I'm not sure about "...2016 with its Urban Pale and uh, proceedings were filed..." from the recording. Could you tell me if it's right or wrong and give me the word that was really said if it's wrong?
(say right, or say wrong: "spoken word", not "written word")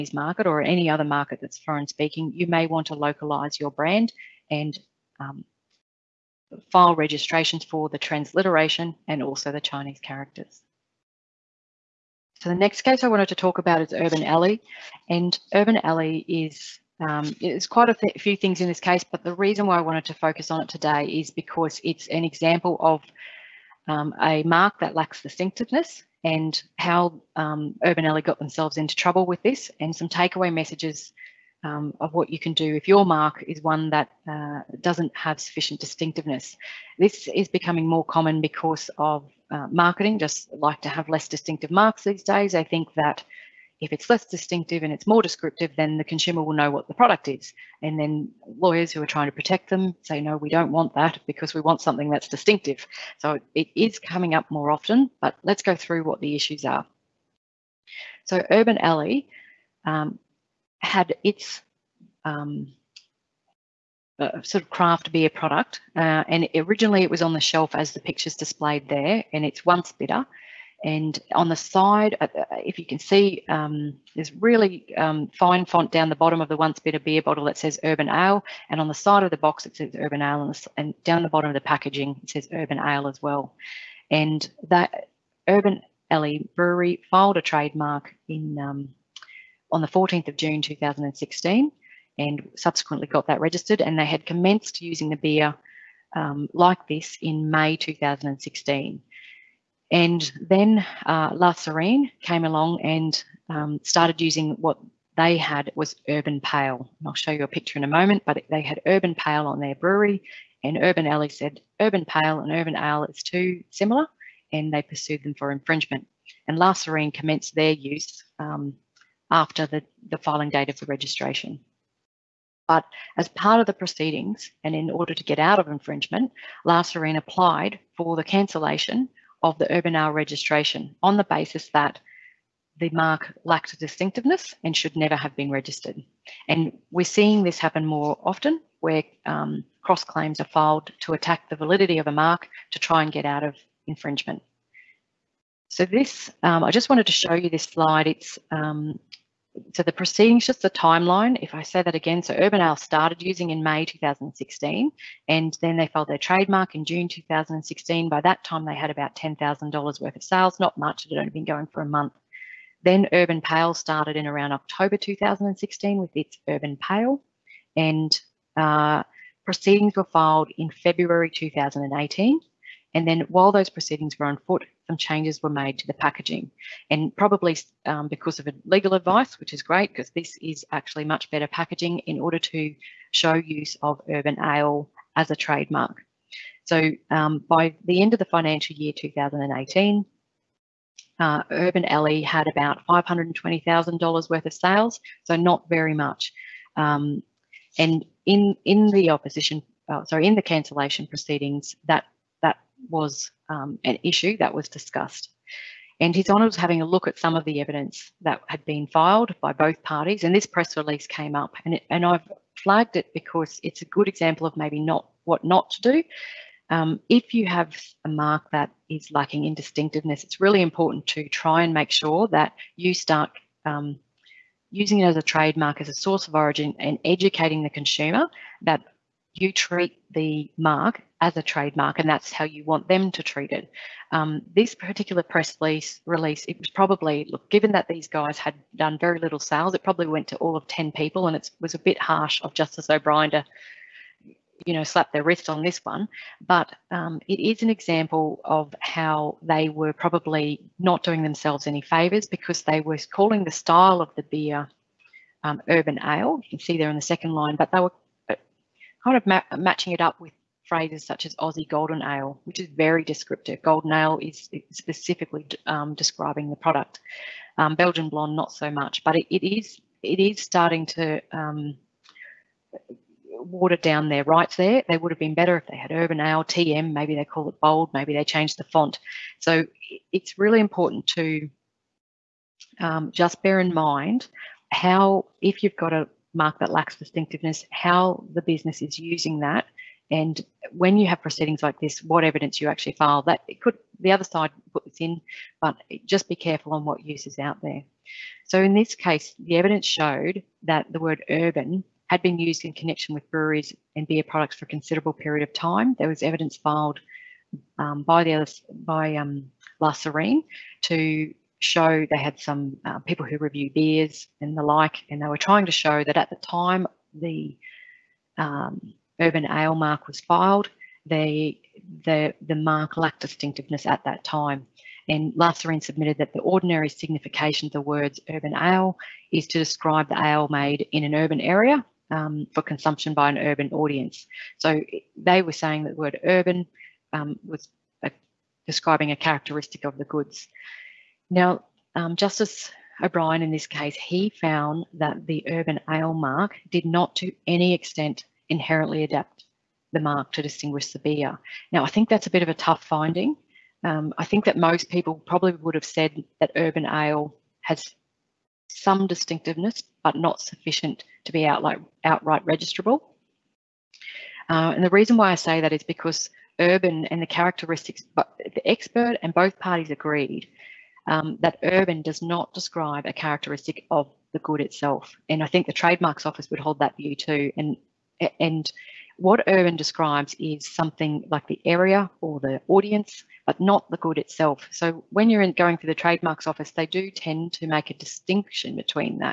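right.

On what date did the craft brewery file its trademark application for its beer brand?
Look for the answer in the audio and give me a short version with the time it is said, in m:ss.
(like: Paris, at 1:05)
14 June 2016, at 1:29.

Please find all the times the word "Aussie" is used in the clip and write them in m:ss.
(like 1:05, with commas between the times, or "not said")
4:21.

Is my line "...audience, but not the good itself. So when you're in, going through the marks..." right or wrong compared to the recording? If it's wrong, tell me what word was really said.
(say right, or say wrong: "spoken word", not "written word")
wrong: "trademarks", not "marks".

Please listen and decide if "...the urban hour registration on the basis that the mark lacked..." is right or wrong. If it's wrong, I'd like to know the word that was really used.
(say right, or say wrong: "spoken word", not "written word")
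right.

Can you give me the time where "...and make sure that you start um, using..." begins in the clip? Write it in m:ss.
3:41.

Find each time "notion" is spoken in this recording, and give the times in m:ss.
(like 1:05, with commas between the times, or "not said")
not said.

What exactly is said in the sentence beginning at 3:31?
And, it, and I've flagged it because it's a good example of maybe not what not to do.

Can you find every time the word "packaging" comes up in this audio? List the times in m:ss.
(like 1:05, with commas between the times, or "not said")
1:21, 2:55, 3:01.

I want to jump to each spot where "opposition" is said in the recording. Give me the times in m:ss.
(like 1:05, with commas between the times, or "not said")
3:19.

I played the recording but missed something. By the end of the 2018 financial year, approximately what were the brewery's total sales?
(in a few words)
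$520,000.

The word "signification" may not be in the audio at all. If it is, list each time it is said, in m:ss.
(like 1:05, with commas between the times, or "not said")
5:26.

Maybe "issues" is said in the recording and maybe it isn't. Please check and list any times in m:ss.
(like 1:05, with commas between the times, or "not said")
0:56, 3:24.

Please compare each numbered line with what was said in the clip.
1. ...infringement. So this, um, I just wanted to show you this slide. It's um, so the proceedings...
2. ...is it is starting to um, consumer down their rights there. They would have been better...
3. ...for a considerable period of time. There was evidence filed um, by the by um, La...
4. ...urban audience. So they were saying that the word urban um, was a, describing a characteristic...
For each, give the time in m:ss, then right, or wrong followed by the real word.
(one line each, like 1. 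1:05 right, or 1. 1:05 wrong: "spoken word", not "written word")
1. 2:23 right
2. 4:29 wrong: "water", not "consumer"
3. 5:04 right
4. 5:33 right.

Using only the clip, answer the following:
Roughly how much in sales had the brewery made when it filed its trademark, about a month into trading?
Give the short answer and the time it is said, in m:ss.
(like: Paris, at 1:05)
$10,000, at 2:39.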